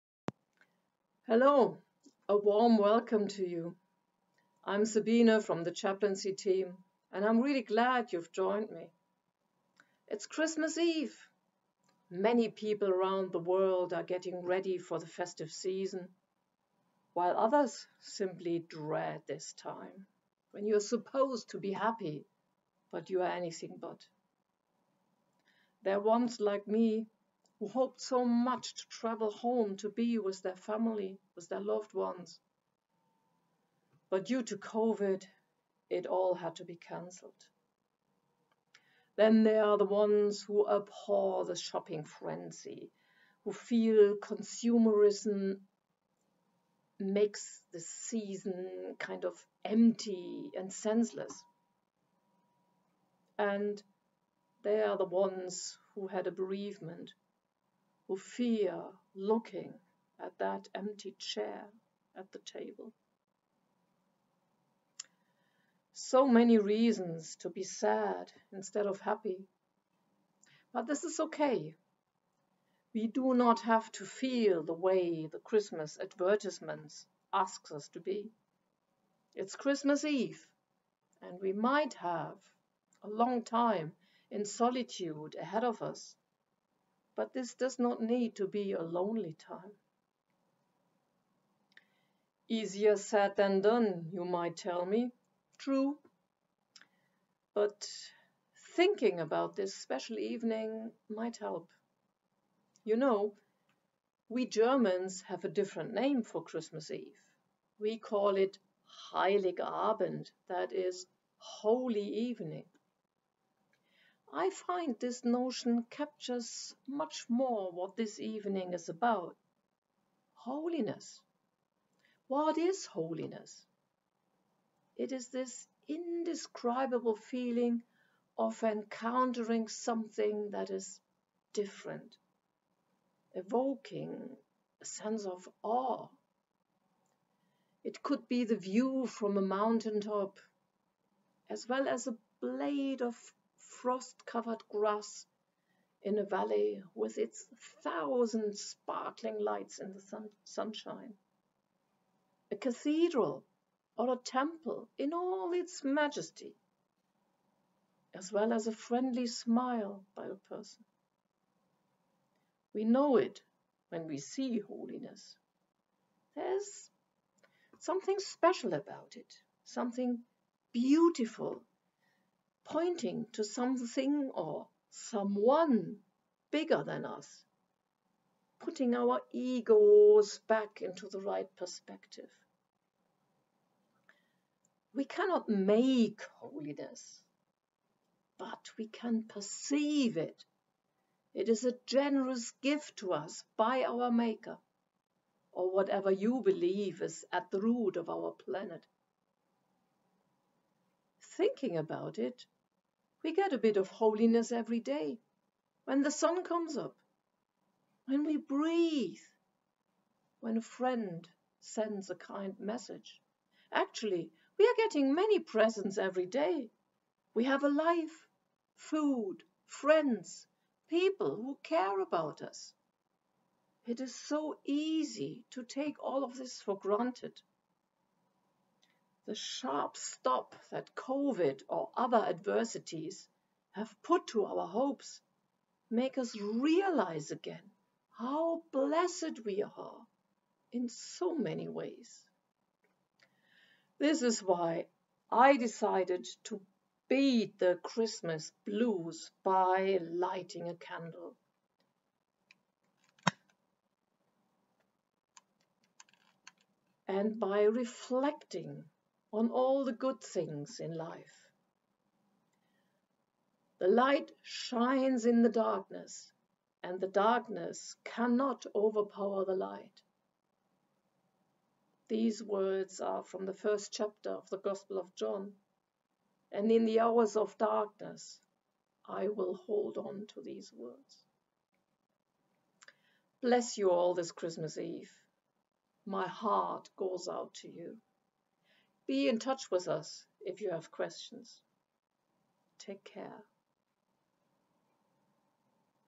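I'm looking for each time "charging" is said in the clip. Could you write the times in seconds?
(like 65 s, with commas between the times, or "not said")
not said.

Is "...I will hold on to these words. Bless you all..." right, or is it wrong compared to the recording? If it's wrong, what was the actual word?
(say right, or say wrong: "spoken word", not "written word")
right.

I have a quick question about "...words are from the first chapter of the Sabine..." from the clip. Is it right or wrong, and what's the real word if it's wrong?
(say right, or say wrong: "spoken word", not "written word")
wrong: "Gospel", not "Sabine".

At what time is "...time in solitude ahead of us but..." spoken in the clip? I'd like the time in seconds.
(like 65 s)
83 s.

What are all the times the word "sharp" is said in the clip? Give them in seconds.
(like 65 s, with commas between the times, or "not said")
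229 s.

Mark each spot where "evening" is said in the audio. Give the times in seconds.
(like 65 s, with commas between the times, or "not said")
100 s, 112 s, 118 s.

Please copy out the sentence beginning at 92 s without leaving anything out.
Easier said than done, you might tell me.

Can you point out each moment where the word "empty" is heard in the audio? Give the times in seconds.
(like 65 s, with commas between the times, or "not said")
49 s, 60 s.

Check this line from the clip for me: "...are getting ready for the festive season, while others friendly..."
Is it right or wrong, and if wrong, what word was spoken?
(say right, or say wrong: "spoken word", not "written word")
wrong: "simply", not "friendly".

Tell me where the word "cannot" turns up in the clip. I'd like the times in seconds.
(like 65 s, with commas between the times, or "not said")
185 s, 268 s.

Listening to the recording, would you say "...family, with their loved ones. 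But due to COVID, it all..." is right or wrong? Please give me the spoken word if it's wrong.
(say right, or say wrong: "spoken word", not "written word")
right.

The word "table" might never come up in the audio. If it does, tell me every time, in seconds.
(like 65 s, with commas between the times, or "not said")
62 s.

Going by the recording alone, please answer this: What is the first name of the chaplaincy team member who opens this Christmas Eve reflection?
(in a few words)
Sabine.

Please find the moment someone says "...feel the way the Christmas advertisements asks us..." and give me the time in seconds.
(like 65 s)
74 s.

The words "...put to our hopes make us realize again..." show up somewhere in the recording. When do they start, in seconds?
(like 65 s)
234 s.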